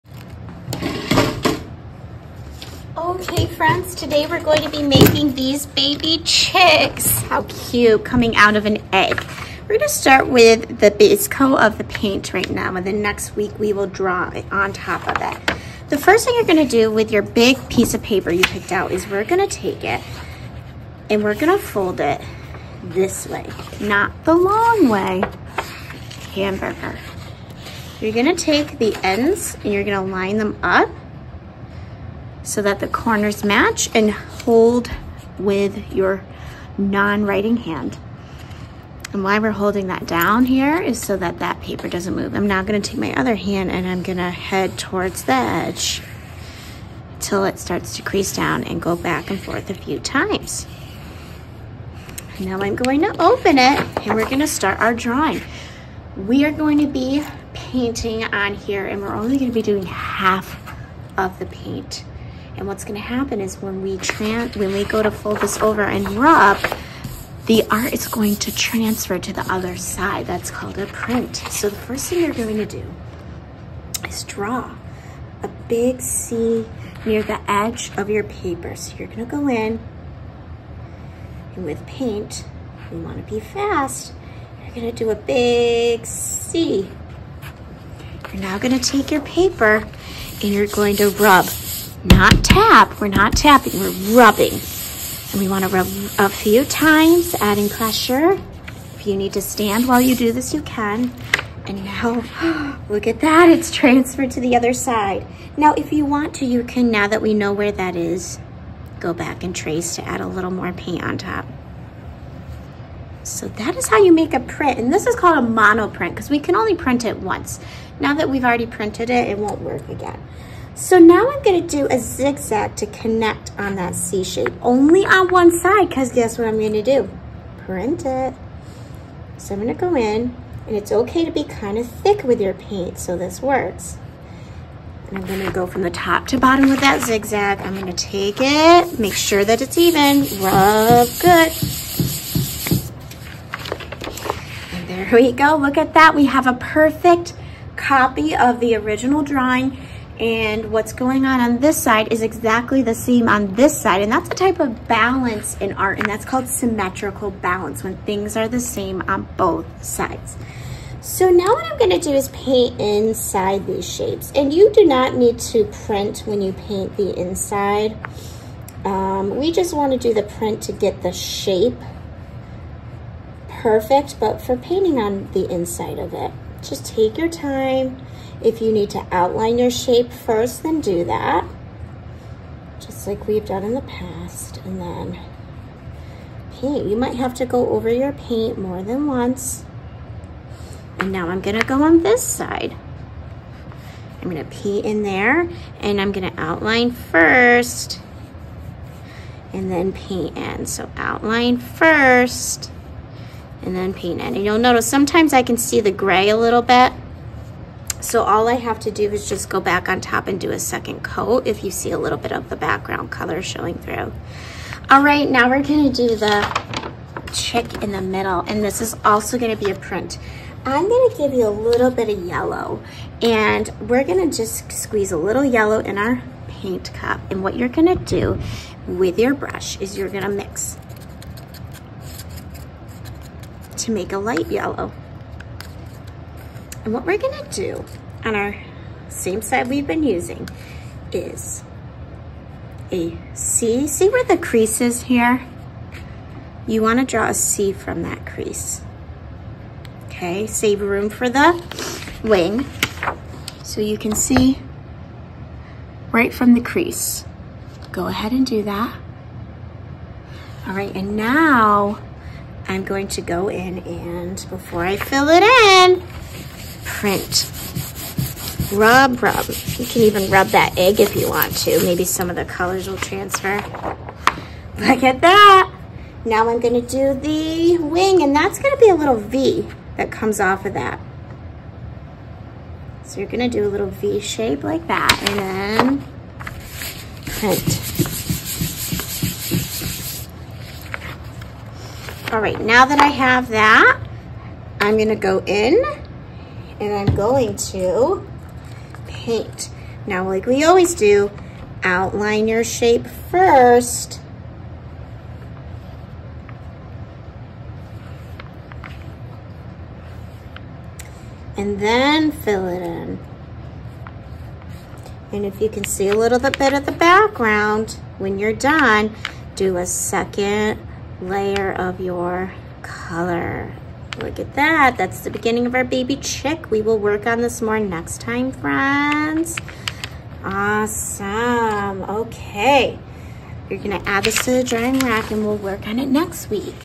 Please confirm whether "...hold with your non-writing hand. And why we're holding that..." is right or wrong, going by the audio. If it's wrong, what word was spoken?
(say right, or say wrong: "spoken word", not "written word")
right.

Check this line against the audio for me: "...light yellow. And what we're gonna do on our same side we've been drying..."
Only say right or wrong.
wrong.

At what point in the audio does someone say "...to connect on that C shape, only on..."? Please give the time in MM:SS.
02:02.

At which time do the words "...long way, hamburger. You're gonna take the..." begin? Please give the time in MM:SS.
00:24.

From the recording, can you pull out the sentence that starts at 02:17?
I'm gonna take it, make sure that it's even, rub good.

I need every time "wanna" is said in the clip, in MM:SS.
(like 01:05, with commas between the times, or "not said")
01:22, 01:35, 02:49, 04:06.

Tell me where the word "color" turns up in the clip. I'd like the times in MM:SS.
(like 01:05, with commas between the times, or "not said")
03:33, 04:32, 05:22.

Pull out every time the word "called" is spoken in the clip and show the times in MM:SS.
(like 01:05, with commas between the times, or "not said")
01:10, 01:55, 02:36.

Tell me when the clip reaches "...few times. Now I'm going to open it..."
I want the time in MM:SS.
00:49.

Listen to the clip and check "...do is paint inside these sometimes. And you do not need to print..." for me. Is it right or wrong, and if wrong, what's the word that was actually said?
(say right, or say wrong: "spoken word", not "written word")
wrong: "shapes", not "sometimes".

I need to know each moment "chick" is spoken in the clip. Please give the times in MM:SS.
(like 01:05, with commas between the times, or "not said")
00:06, 03:37, 05:26.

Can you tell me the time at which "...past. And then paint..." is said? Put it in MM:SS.
03:03.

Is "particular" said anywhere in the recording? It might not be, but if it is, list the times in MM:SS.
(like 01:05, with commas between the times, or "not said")
not said.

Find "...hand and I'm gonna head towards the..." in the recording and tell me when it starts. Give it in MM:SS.
00:43.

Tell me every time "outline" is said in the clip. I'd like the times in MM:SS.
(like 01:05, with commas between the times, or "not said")
02:59, 03:16, 03:20, 05:01.